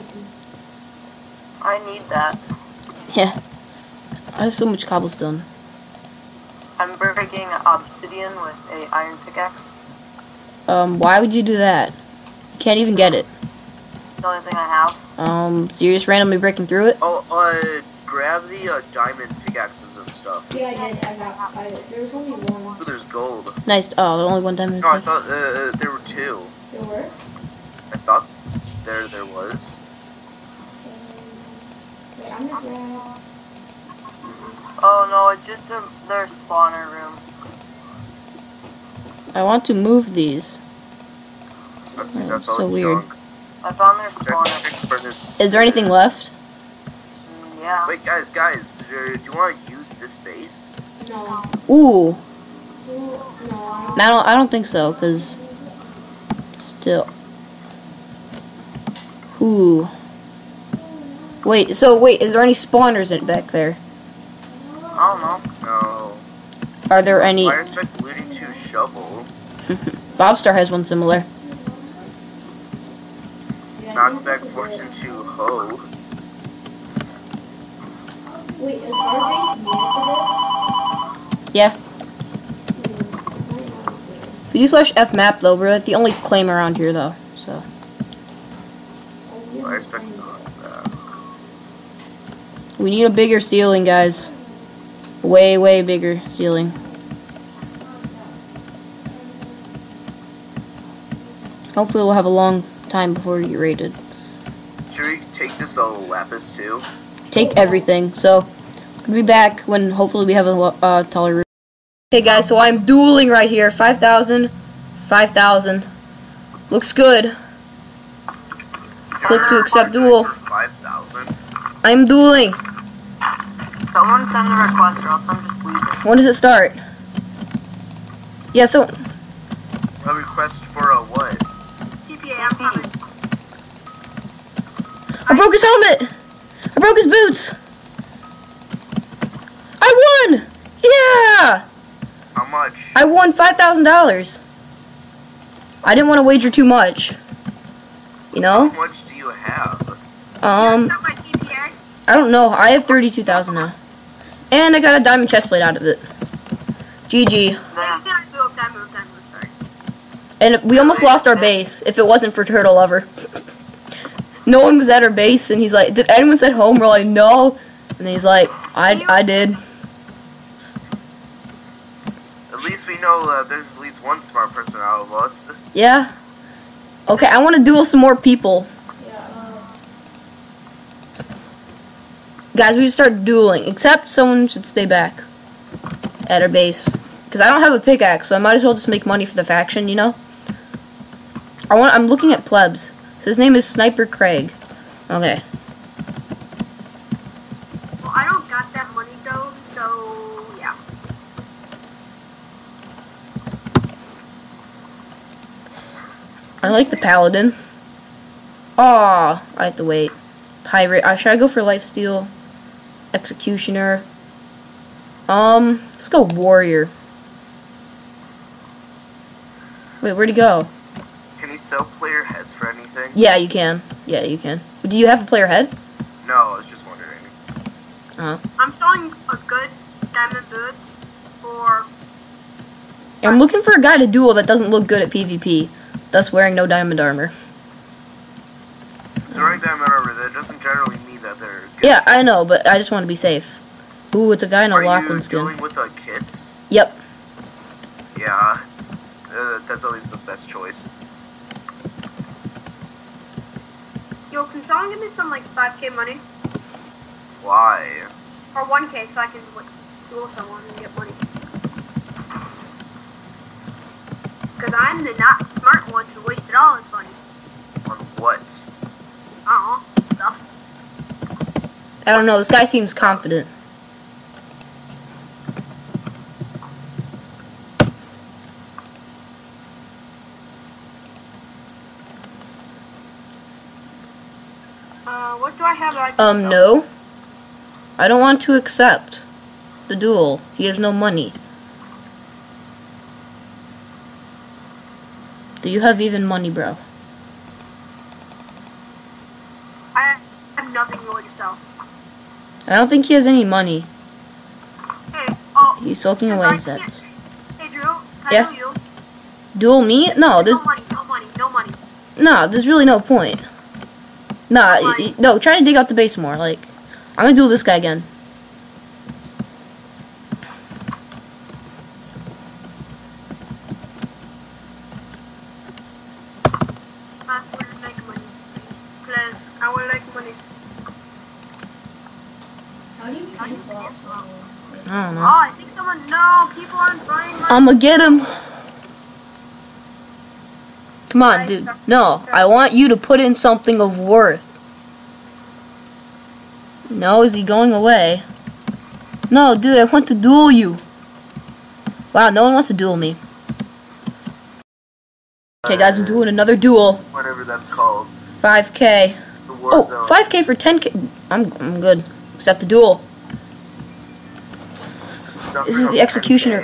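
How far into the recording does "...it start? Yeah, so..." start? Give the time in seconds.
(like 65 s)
126 s.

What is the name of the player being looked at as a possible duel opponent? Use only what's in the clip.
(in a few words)
Sniper Craig.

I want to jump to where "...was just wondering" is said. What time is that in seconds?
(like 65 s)
226 s.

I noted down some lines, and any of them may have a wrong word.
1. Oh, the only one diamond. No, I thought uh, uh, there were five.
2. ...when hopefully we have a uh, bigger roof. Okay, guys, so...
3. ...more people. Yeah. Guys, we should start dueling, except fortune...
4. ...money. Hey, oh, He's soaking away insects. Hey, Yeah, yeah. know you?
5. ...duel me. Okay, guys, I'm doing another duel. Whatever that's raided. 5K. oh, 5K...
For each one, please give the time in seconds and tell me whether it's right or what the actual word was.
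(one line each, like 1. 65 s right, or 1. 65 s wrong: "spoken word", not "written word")
1. 23 s wrong: "two", not "five"
2. 109 s wrong: "taller", not "bigger"
3. 177 s wrong: "someone", not "fortune"
4. 303 s wrong: "Drew", not "Yeah"
5. 352 s wrong: "called", not "raided".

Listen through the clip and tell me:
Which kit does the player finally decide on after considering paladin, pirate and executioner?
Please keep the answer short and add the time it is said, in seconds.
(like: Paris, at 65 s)
Warrior, at 216 s.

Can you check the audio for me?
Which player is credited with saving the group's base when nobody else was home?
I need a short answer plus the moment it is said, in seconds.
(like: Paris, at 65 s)
Turtle Lover, at 162 s.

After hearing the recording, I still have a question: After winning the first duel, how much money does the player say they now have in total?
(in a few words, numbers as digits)
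32,000.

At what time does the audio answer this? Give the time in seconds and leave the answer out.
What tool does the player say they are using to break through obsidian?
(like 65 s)
8 s.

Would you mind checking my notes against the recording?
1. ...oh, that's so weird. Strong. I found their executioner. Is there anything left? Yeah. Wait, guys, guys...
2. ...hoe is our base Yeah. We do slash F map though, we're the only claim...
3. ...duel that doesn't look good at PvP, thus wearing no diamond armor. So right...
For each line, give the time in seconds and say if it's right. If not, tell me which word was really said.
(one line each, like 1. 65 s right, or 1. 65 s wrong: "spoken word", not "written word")
1. 42 s wrong: "spawner", not "executioner"
2. 75 s right
3. 234 s right.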